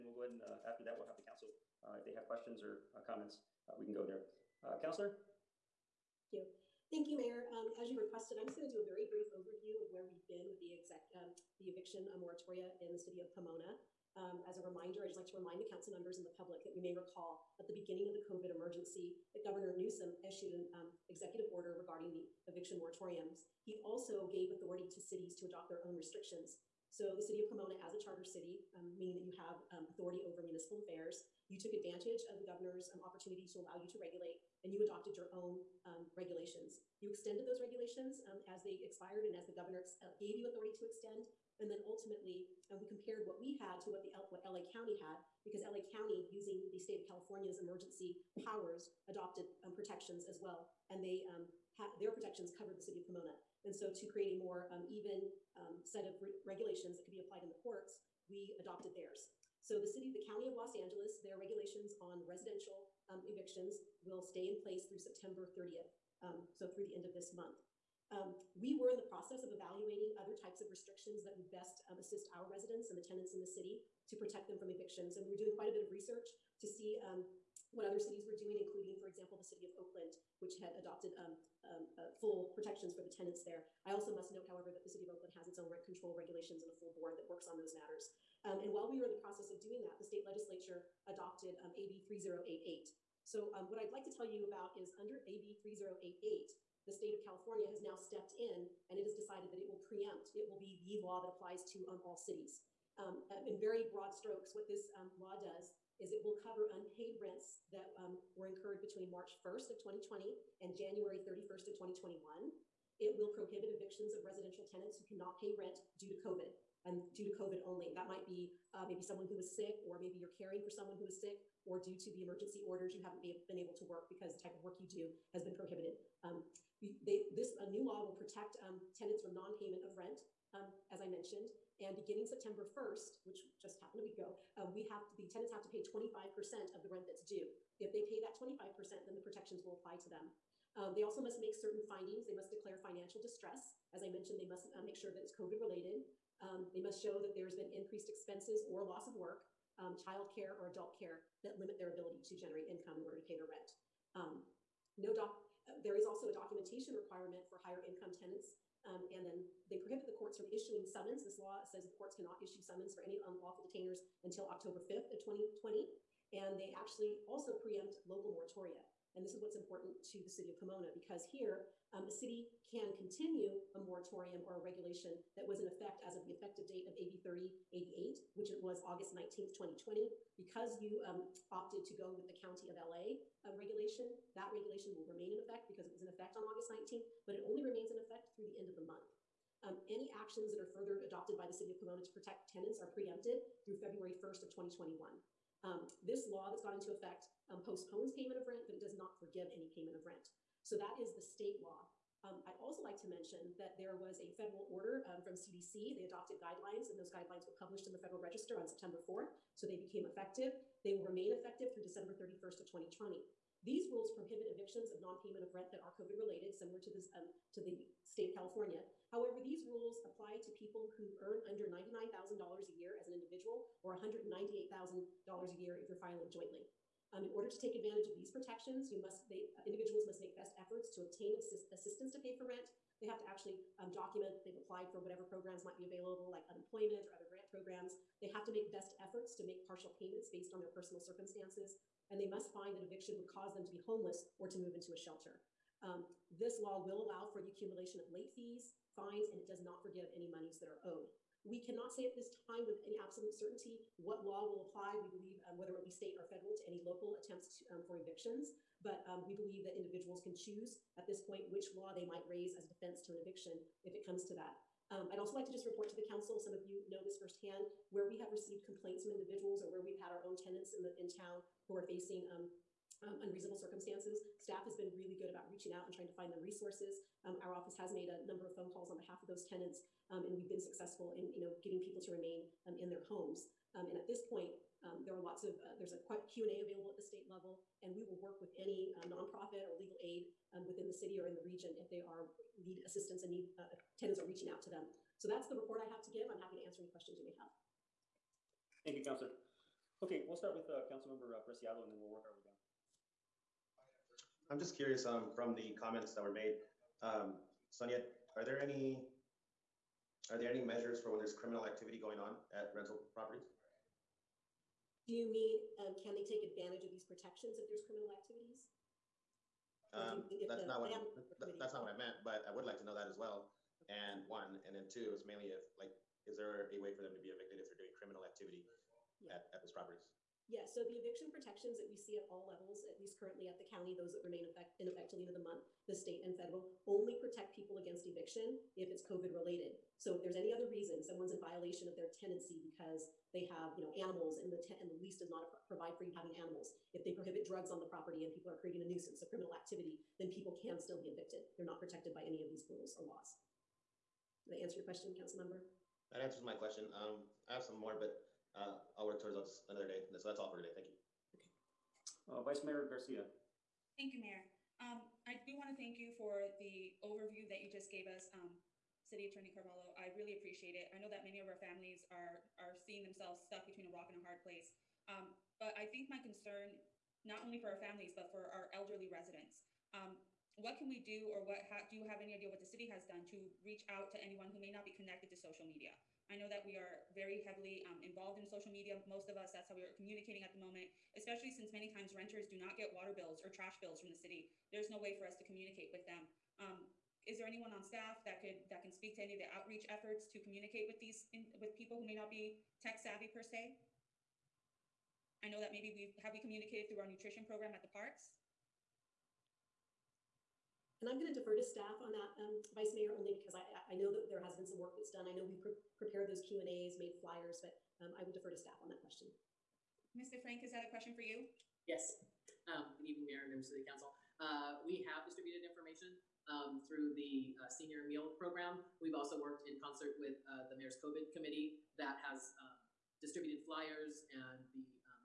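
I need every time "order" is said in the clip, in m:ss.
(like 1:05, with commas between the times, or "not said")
0:21, 2:02, 2:33, 3:24, 3:47.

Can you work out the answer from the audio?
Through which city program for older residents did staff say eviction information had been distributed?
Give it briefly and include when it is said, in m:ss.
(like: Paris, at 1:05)
senior meal program, at 7:07.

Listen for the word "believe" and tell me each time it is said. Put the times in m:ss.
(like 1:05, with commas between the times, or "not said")
4:15, 4:19.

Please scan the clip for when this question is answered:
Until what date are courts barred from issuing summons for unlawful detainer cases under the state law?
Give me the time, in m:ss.
2:44.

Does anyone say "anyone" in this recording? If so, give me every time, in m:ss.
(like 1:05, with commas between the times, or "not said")
6:24, 6:37.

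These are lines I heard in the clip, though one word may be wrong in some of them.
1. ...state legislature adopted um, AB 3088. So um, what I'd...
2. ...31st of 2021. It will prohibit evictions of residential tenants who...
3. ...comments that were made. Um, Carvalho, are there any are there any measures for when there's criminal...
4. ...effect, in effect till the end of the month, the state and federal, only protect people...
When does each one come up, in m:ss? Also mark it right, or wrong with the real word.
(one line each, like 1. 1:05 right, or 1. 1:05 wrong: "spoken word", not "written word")
1. 1:30 right
2. 1:51 right
3. 5:05 wrong: "Sonia", not "Carvalho"
4. 5:34 right.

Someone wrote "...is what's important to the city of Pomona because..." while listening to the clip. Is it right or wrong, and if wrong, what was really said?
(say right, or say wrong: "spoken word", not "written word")
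right.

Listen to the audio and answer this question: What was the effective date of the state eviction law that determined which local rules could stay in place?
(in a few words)
August 19th, 2020.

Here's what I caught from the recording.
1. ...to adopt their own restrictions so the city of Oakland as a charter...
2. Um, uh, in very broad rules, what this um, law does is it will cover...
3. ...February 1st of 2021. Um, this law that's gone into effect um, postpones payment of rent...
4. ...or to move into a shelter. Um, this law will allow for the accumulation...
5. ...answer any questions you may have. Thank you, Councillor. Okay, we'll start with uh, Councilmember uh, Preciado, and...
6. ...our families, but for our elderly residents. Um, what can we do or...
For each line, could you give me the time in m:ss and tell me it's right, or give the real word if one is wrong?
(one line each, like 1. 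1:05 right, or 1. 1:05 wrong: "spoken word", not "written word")
1. 0:25 wrong: "Pomona", not "Oakland"
2. 1:42 wrong: "strokes", not "rules"
3. 3:13 right
4. 4:04 right
5. 4:56 right
6. 6:17 right.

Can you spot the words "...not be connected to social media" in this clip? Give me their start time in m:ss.
6:24.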